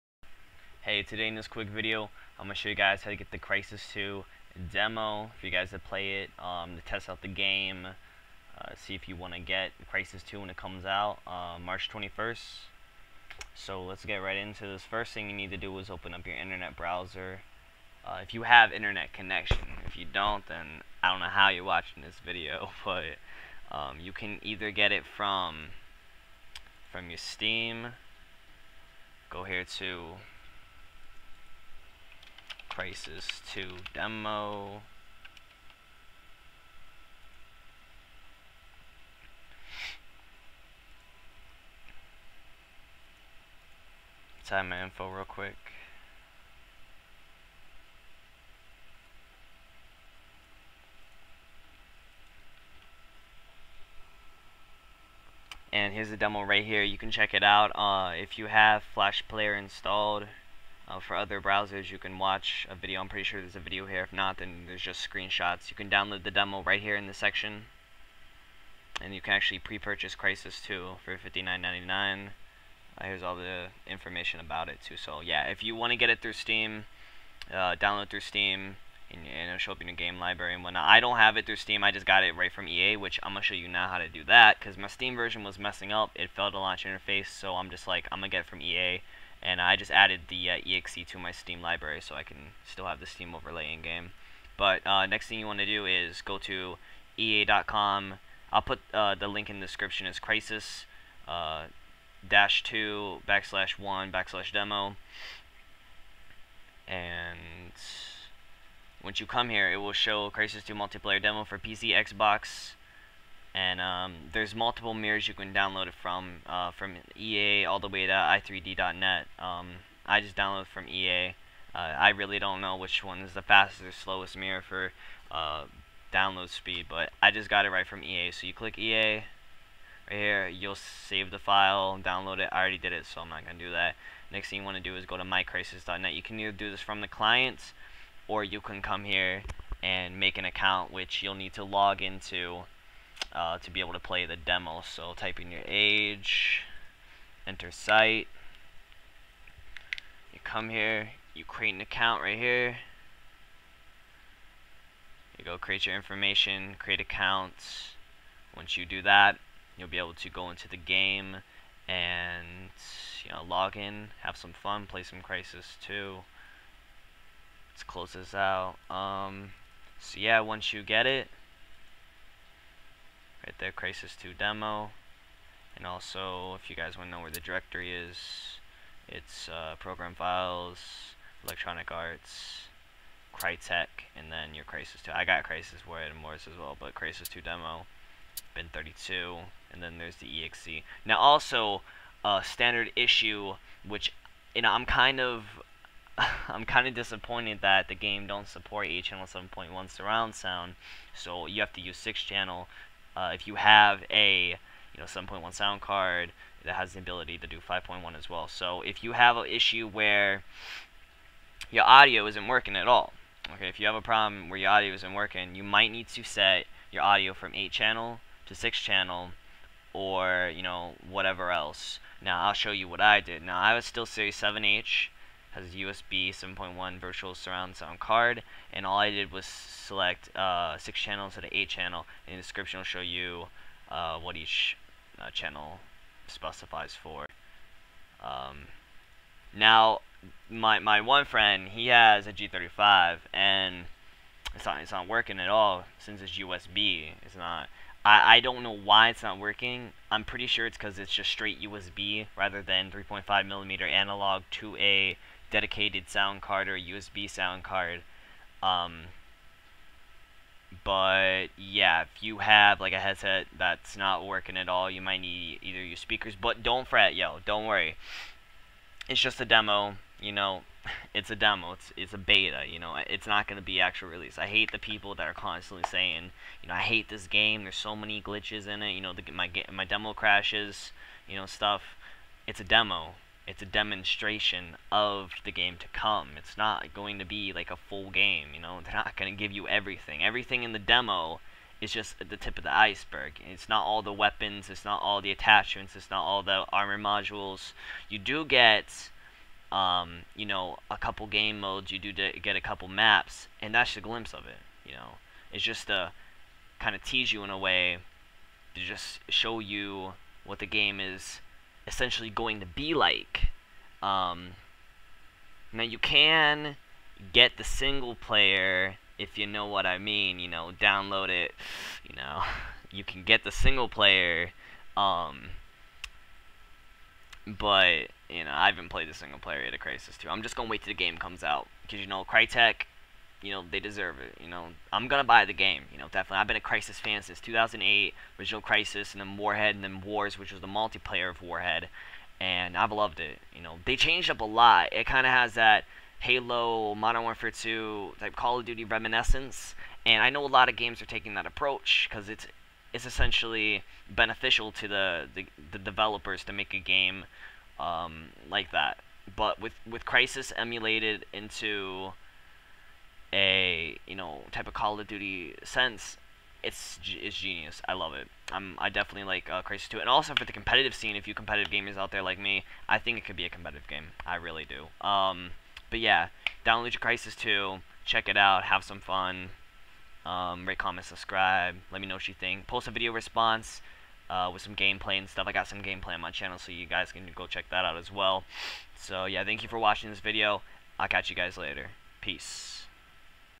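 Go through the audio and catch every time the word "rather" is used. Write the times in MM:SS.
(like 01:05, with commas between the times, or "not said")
04:12.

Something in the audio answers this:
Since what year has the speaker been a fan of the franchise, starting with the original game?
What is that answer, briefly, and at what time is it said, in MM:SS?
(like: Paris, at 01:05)
2008, at 05:37.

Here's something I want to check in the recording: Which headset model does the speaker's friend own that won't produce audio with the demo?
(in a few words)
G35.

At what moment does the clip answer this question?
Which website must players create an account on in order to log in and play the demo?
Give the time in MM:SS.
02:15.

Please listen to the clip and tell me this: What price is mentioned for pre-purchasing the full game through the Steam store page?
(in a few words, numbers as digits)
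$59.99.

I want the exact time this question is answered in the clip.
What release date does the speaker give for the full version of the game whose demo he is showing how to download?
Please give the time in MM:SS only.
00:11.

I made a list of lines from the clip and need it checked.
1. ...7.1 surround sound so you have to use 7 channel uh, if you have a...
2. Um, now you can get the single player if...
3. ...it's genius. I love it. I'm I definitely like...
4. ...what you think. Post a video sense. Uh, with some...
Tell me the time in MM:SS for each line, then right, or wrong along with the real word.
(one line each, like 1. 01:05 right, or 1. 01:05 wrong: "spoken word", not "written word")
1. 03:19 wrong: "6", not "7"
2. 05:14 right
3. 06:07 right
4. 06:22 wrong: "response", not "sense".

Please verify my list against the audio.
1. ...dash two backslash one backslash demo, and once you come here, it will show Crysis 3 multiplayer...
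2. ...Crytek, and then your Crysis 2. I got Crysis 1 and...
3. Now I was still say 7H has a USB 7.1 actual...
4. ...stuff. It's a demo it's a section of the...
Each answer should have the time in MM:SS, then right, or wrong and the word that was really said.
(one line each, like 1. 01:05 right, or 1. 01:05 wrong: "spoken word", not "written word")
1. 01:42 wrong: "2", not "3"
2. 03:03 right
3. 03:43 wrong: "virtual", not "actual"
4. 04:41 wrong: "demonstration", not "section".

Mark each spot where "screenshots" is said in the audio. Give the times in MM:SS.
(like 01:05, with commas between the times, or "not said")
01:05.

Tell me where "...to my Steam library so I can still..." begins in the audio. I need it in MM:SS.
01:31.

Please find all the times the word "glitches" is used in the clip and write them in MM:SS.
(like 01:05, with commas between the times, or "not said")
04:38.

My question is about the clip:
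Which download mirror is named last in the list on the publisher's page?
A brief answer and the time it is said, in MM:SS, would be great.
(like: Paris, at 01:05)
i3d.net, at 01:58.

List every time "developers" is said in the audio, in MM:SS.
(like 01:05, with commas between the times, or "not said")
05:55.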